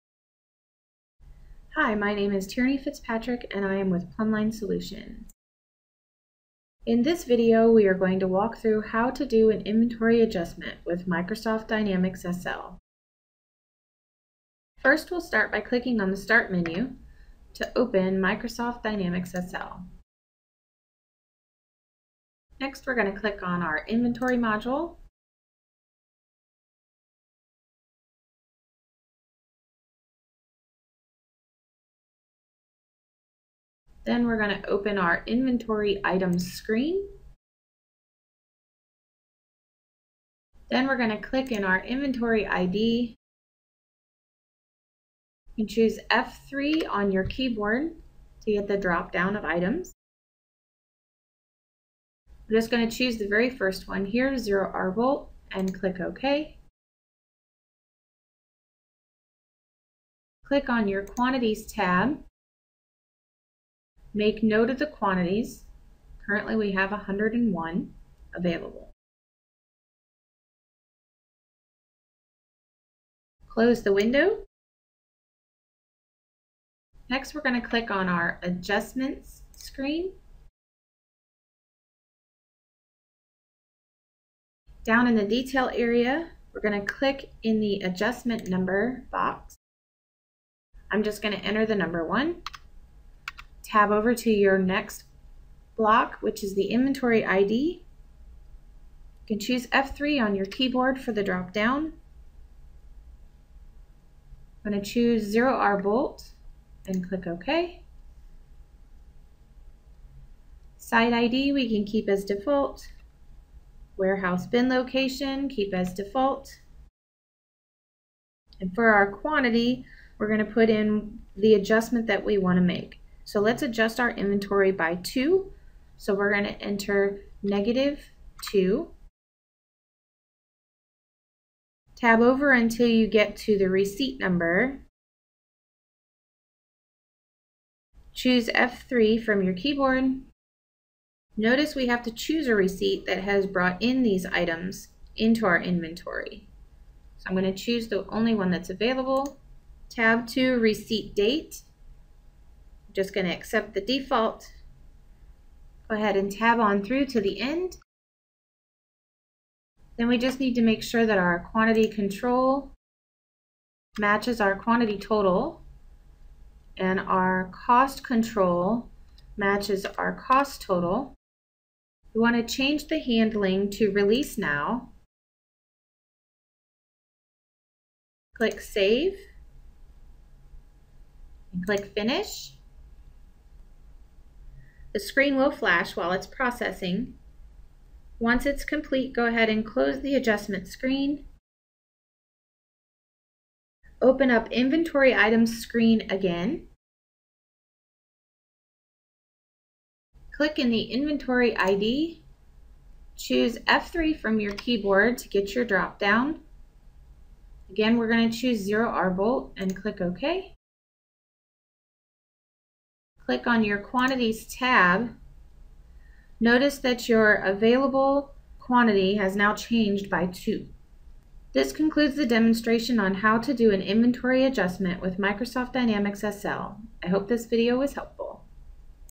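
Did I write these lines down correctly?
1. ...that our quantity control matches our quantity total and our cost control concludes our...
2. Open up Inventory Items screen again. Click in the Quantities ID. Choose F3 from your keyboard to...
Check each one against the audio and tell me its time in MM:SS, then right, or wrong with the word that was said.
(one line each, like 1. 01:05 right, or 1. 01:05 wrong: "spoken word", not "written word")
1. 02:41 wrong: "matches", not "concludes"
2. 03:14 wrong: "Inventory", not "Quantities".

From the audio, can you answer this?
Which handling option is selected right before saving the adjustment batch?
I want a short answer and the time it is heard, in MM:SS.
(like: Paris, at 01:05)
Release now, at 02:53.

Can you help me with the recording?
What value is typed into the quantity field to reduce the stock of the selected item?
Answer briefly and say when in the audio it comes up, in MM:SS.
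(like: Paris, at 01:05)
-2, at 02:07.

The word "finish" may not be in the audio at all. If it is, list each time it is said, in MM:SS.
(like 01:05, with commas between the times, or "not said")
03:01.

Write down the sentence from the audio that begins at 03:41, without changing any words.
This concludes the demonstration on how to do an inventory adjustment with Microsoft Dynamics SL.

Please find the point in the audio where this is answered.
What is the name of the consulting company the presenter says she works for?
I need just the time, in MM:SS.
00:04.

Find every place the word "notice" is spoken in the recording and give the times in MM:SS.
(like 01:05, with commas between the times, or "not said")
02:21, 03:36.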